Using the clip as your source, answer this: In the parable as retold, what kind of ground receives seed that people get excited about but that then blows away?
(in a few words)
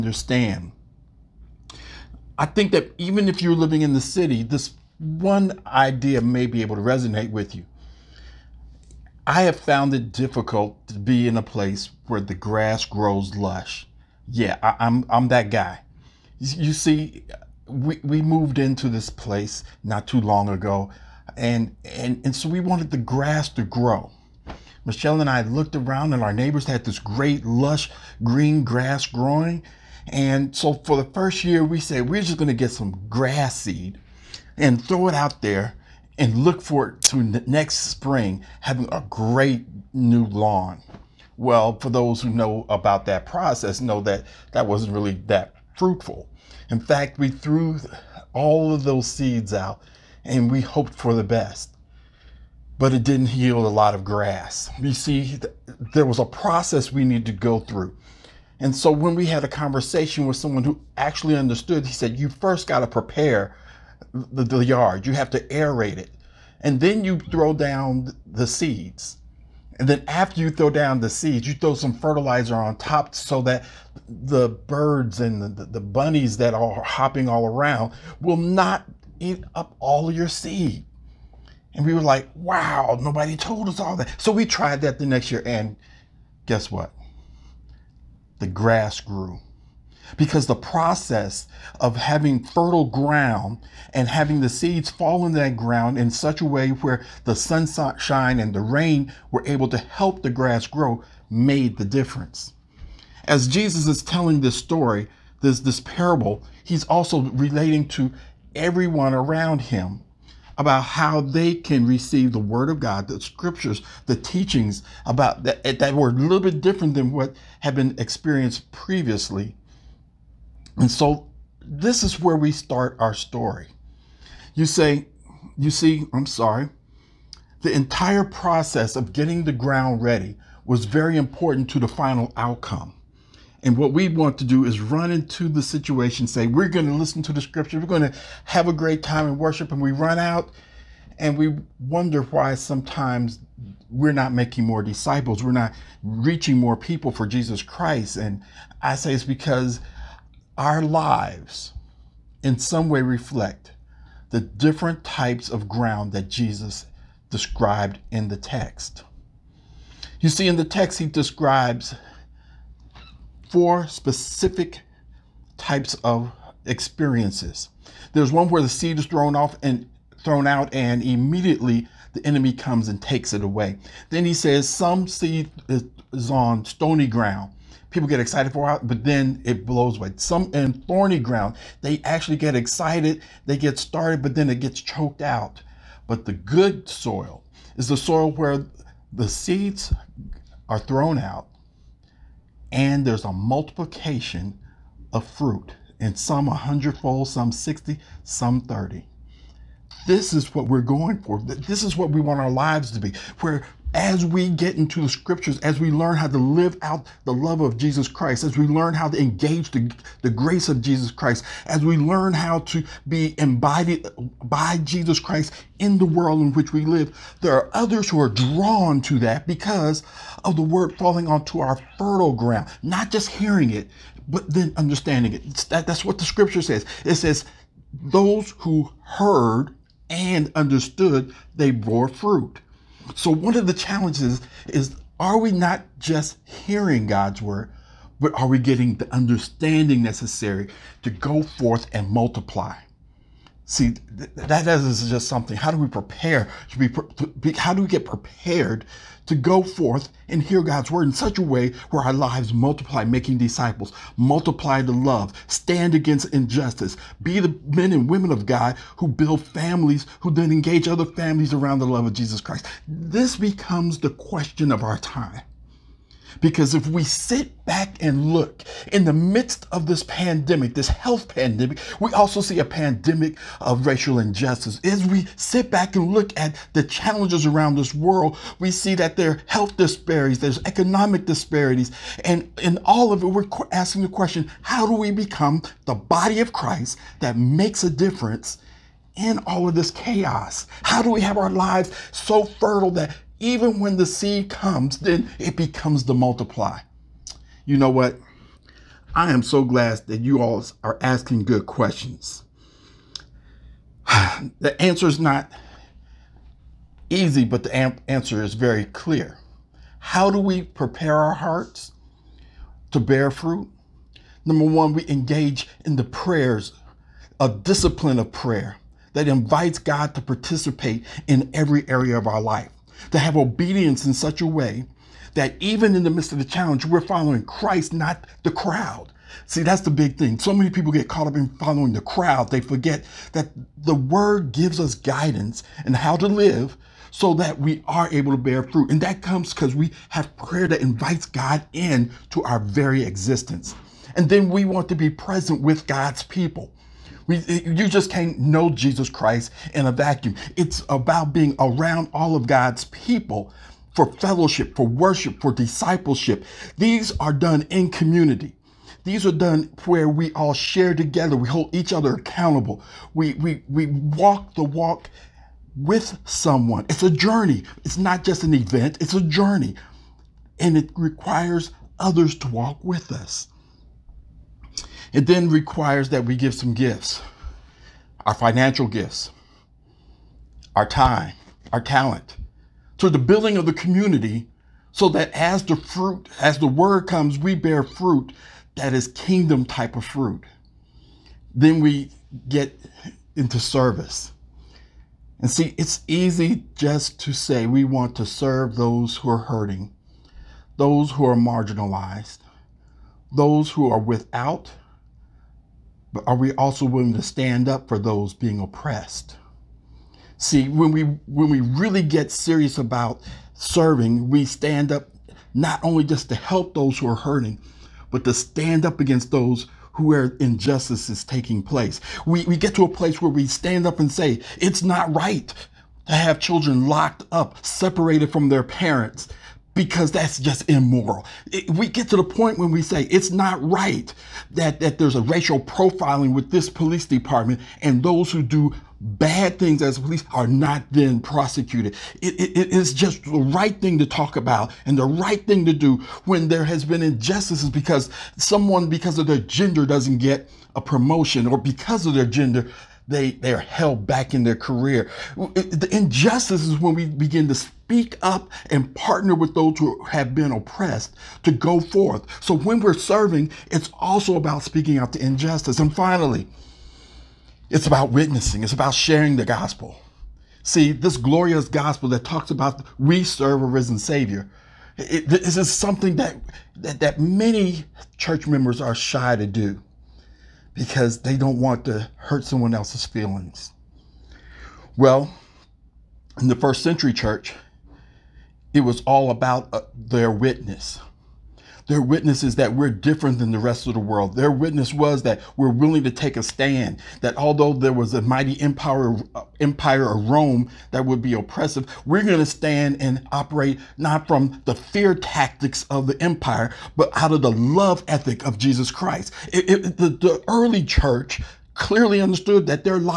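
stony ground.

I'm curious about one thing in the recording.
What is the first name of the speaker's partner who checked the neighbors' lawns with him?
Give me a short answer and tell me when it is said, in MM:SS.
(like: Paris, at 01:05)
Michelle, at 00:24.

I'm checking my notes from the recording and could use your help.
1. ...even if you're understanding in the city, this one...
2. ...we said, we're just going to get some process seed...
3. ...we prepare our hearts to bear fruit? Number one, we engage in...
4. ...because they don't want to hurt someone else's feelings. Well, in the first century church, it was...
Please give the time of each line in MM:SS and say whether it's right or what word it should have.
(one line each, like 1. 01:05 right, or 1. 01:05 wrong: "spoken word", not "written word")
1. 00:02 wrong: "living", not "understanding"
2. 00:31 wrong: "grass", not "process"
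3. 05:10 right
4. 08:00 right.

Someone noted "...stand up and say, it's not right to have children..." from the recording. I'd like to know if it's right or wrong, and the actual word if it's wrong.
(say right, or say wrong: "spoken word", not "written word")
right.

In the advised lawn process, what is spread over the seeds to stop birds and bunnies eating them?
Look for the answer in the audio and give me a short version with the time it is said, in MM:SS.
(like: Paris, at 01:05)
fertilizer, at 01:11.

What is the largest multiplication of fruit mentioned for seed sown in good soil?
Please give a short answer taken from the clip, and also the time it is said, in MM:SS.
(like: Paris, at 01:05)
100 fold, at 03:16.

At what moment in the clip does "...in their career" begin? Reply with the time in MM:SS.
07:34.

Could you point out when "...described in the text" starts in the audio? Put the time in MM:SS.
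02:37.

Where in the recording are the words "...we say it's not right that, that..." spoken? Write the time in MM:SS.
07:12.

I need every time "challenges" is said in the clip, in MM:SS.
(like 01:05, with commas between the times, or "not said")
03:53, 04:36, 05:26.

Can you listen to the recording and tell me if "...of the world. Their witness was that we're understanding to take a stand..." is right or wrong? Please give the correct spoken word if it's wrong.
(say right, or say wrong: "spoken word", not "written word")
wrong: "willing", not "understanding".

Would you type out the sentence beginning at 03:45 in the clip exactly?
That, that's what the scripture says.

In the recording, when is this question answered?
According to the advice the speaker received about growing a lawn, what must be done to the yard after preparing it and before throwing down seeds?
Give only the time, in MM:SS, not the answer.
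01:05.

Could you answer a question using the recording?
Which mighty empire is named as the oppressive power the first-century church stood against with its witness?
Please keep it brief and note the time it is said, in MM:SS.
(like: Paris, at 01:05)
Rome, at 08:20.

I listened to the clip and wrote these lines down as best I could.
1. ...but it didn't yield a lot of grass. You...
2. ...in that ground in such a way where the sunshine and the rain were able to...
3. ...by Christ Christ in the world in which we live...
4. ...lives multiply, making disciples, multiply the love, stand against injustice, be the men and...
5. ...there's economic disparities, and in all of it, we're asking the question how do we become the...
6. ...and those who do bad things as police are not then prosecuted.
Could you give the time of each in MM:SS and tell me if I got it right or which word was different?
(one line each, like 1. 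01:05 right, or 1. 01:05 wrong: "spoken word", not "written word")
1. 00:52 right
2. 01:35 right
3. 03:34 wrong: "Jesus", not "Christ"
4. 04:12 right
5. 04:40 right
6. 07:17 right.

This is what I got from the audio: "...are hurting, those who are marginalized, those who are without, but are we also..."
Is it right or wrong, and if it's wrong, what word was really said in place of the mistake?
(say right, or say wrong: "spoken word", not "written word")
right.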